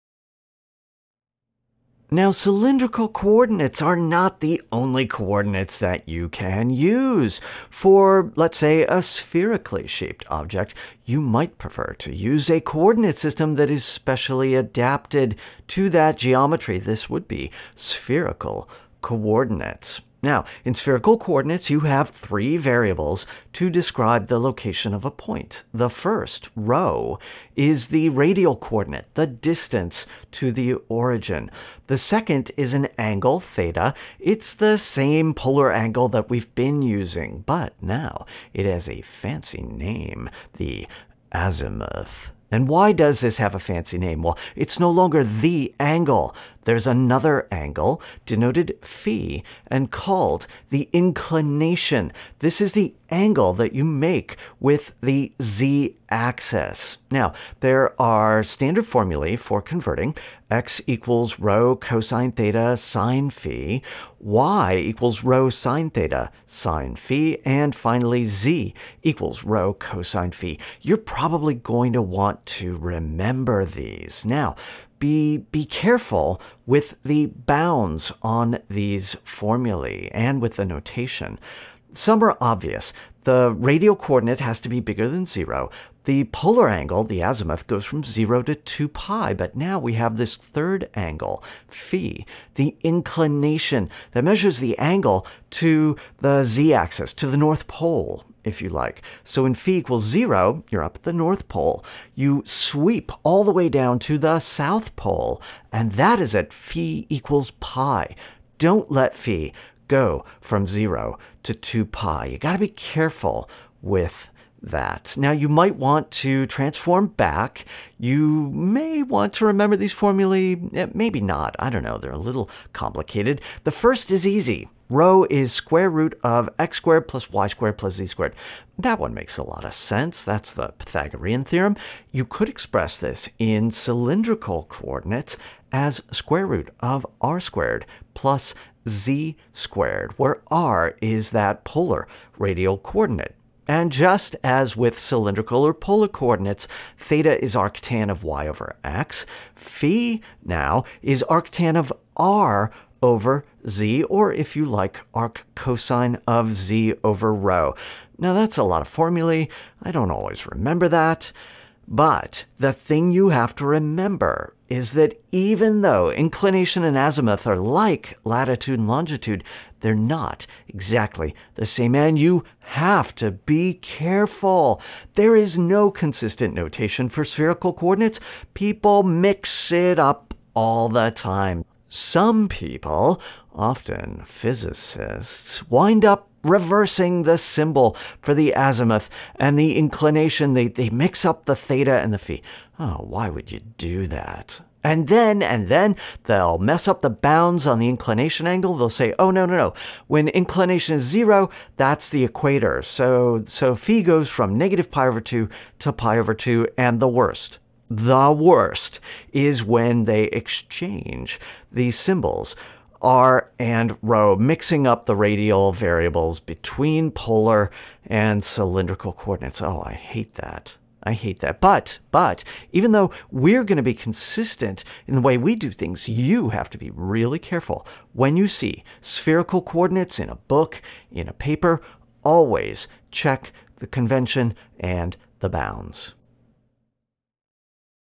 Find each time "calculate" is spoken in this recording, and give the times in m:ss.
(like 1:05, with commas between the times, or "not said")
not said.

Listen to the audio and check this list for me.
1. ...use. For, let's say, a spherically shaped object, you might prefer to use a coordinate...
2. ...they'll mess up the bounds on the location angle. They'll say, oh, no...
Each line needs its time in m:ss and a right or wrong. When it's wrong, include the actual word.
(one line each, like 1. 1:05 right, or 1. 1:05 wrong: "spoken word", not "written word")
1. 0:06 right
2. 3:16 wrong: "inclination", not "location".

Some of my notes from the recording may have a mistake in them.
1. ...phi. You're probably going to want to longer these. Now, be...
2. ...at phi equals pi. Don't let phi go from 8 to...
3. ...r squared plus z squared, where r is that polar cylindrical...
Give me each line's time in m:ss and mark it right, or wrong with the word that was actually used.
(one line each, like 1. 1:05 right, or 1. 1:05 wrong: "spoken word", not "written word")
1. 1:10 wrong: "remember", not "longer"
2. 1:46 wrong: "0", not "8"
3. 2:17 wrong: "radial", not "cylindrical".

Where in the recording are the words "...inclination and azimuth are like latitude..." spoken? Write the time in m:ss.
2:46.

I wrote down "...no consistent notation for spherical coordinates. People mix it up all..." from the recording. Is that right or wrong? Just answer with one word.
right.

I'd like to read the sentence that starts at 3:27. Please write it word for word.
The worst is when they exchange these symbols.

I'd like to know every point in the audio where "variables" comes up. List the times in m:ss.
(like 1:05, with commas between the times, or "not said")
0:22, 3:35.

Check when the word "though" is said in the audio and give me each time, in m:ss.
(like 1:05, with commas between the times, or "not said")
2:45, 3:42.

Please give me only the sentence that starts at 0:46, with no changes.
There's another angle denoted phi and called the inclination.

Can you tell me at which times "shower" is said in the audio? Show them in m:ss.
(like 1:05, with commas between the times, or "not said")
not said.